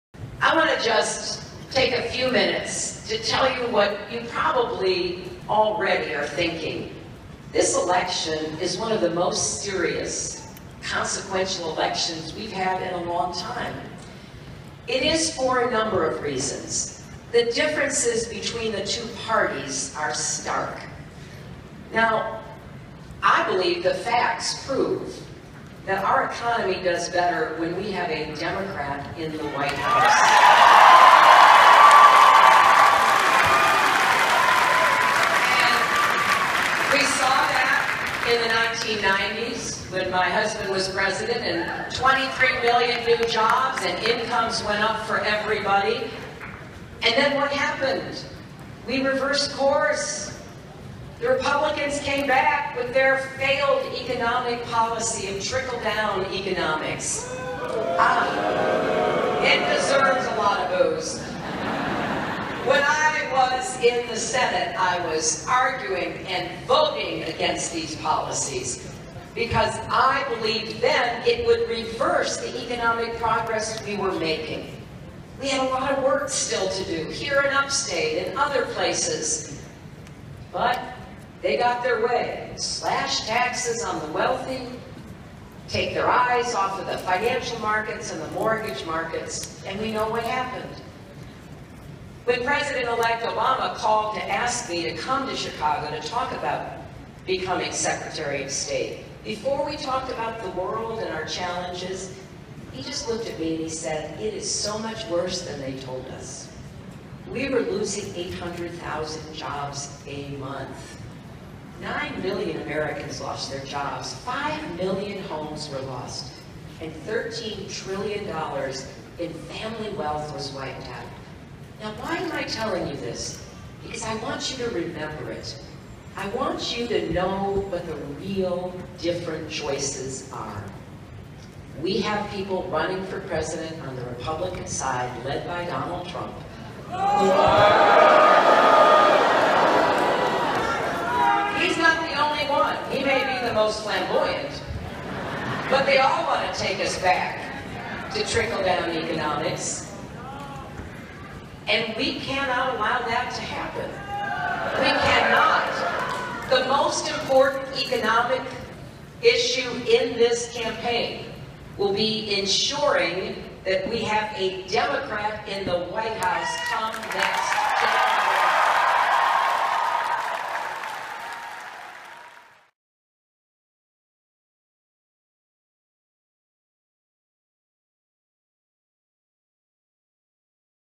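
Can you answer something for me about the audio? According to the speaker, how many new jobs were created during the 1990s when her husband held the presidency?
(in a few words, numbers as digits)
23 million.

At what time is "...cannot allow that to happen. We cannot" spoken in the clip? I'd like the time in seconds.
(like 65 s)
152 s.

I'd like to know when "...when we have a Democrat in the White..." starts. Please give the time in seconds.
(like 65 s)
27 s.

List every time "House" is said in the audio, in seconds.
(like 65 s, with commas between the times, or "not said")
29 s, 166 s.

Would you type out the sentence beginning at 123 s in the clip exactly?
Because I want you to remember it.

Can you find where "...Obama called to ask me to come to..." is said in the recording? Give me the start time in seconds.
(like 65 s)
93 s.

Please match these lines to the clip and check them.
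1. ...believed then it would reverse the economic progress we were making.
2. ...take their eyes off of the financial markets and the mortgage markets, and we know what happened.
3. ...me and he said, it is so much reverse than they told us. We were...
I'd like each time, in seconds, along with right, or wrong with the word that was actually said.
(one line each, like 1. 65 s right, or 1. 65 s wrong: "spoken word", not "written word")
1. 70 s right
2. 85 s right
3. 103 s wrong: "worse", not "reverse".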